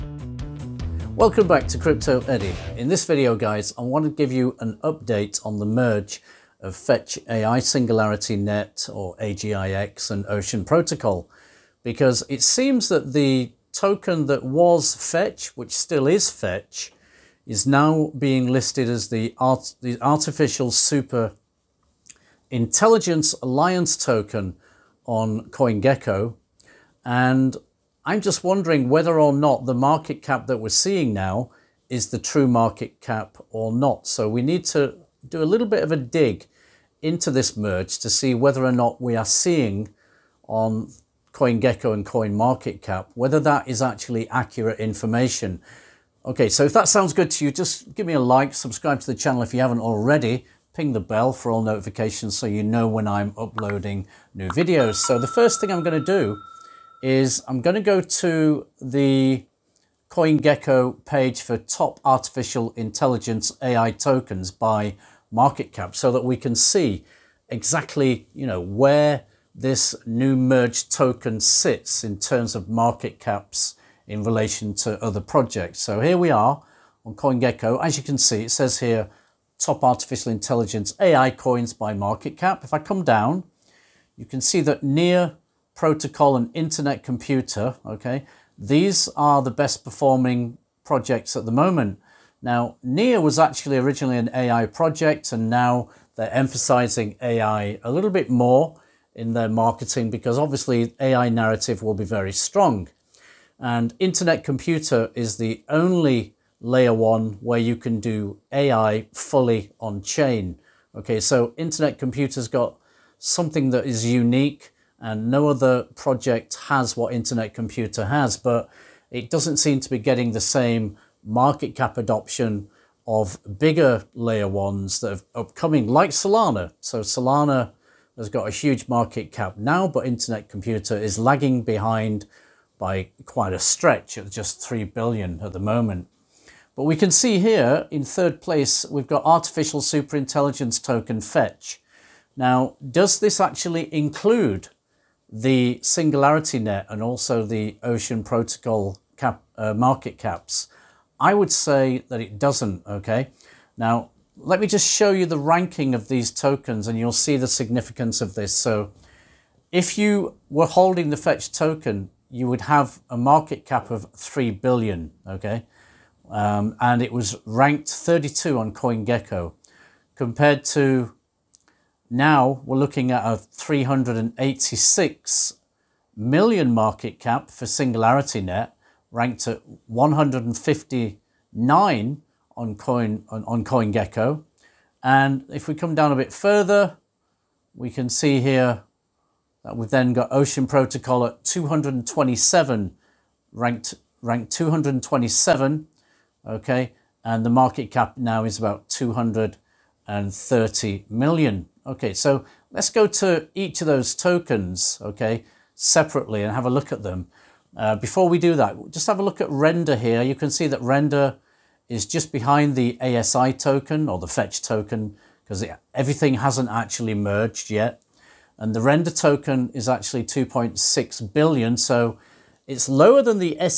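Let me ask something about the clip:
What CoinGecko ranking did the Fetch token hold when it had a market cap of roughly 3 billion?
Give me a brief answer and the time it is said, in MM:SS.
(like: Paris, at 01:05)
32, at 02:47.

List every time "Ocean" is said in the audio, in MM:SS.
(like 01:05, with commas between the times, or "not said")
00:10, 02:27, 03:10.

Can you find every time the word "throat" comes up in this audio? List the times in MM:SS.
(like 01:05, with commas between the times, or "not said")
not said.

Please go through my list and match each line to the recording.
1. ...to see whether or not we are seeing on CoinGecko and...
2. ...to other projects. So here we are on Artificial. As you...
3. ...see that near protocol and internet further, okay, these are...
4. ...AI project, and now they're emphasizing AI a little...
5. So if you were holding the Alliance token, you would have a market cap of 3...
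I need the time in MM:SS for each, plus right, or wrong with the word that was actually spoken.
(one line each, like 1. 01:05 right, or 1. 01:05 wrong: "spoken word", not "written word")
1. 00:37 right
2. 01:14 wrong: "CoinGecko", not "Artificial"
3. 01:24 wrong: "computer", not "further"
4. 01:34 right
5. 02:38 wrong: "Fetch", not "Alliance".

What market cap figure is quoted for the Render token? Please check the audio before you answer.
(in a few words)
2.6 billion.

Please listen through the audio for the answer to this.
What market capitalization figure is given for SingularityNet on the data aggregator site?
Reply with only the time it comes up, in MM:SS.
02:53.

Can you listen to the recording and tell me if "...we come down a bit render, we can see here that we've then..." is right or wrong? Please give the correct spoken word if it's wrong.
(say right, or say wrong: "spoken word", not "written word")
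wrong: "further", not "render".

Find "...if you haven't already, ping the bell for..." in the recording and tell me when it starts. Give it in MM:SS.
00:49.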